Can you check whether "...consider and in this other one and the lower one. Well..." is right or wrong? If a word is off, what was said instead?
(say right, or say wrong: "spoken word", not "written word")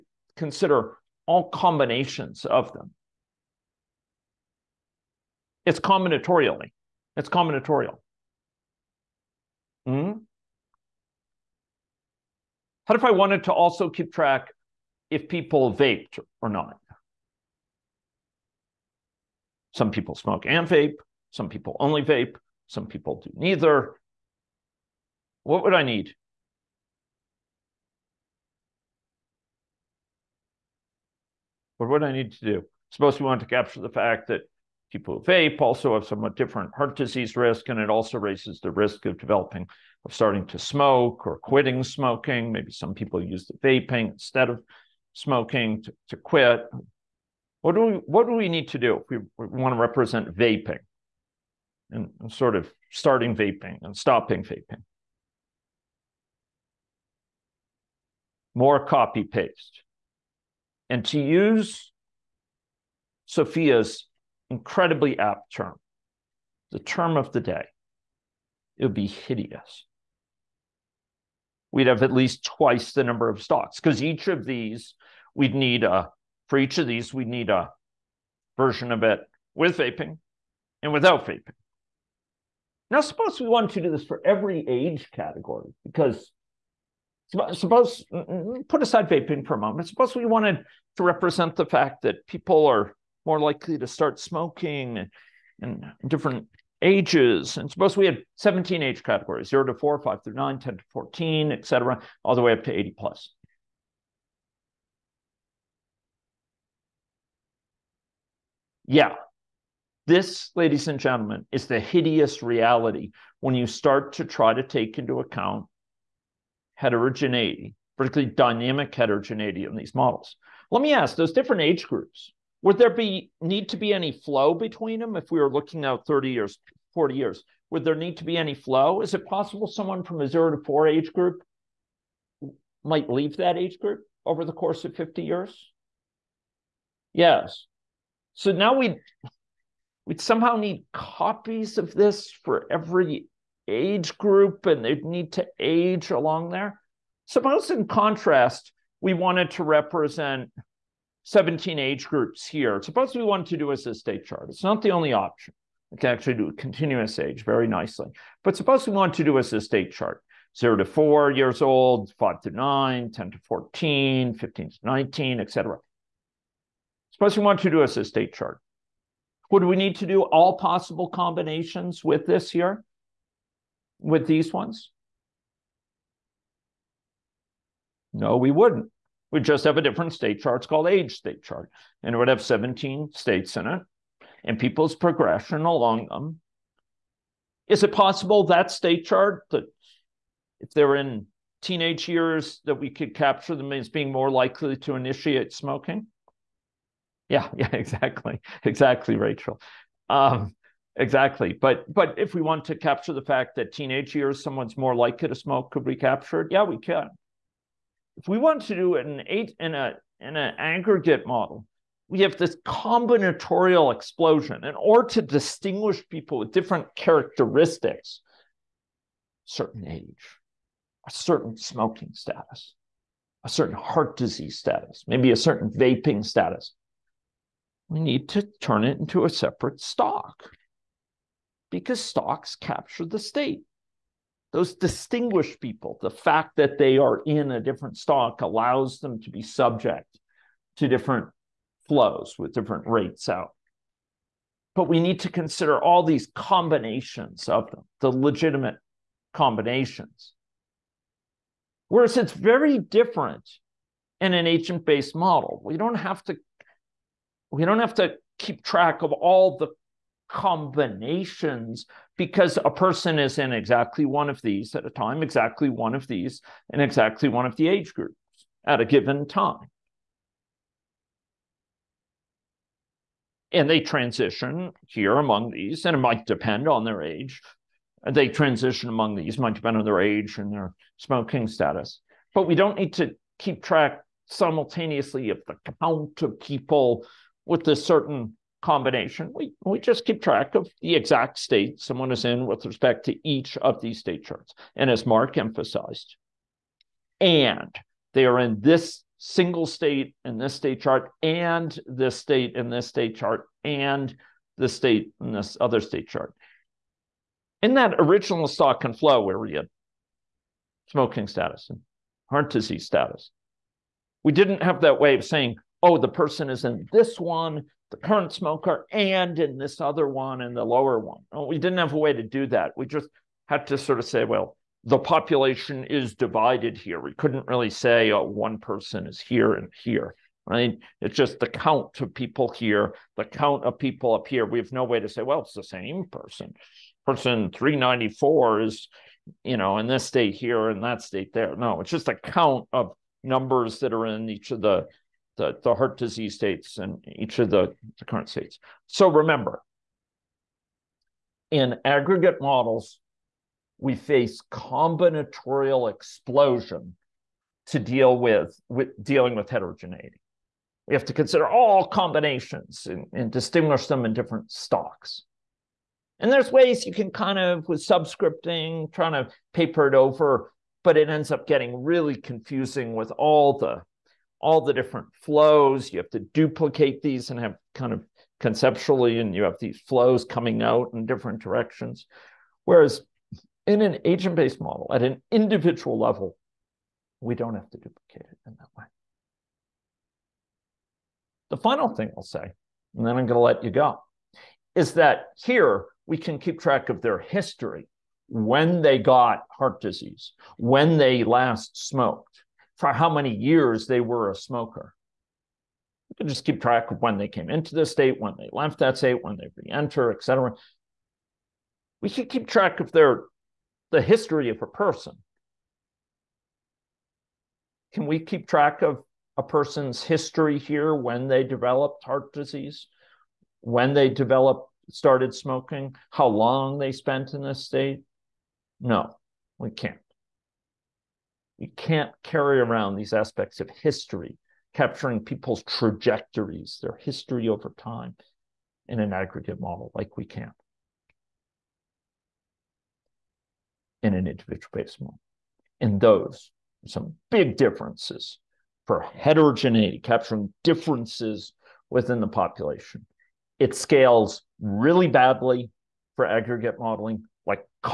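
wrong: "smoker", not "consider".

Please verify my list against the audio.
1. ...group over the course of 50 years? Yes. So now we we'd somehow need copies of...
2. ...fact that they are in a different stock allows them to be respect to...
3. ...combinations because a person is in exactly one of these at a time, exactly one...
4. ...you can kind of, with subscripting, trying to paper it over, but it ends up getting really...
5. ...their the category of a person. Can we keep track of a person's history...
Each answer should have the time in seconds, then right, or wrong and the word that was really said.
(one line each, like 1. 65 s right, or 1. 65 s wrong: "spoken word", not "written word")
1. 133 s right
2. 236 s wrong: "subject", not "respect"
3. 260 s right
4. 366 s right
5. 412 s wrong: "history", not "category".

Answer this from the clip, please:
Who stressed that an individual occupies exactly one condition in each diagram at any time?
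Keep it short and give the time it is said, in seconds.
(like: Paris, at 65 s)
Mark, at 295 s.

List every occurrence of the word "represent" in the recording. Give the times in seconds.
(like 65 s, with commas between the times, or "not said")
49 s, 91 s, 149 s.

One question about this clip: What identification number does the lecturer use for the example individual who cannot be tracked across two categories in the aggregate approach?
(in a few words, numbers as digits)
394.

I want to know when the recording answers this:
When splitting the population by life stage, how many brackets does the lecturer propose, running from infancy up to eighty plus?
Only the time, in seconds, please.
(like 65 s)
98 s.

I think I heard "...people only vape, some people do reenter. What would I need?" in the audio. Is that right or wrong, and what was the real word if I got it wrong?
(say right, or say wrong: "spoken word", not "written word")
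wrong: "neither", not "reenter".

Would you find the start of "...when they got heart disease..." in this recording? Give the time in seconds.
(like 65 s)
398 s.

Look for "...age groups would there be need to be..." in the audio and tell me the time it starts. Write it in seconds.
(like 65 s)
121 s.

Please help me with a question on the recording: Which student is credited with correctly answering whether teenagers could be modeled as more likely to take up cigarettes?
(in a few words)
Rachel.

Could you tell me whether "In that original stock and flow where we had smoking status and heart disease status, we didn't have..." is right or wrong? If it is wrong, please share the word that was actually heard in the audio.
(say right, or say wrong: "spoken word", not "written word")
right.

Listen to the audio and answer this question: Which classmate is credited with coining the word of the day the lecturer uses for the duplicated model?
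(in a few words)
Sophia.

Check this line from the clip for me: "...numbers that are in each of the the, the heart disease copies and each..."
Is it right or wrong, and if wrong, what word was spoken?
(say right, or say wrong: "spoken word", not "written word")
wrong: "states", not "copies".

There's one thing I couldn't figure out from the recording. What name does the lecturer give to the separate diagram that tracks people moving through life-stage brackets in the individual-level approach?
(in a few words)
age state chart.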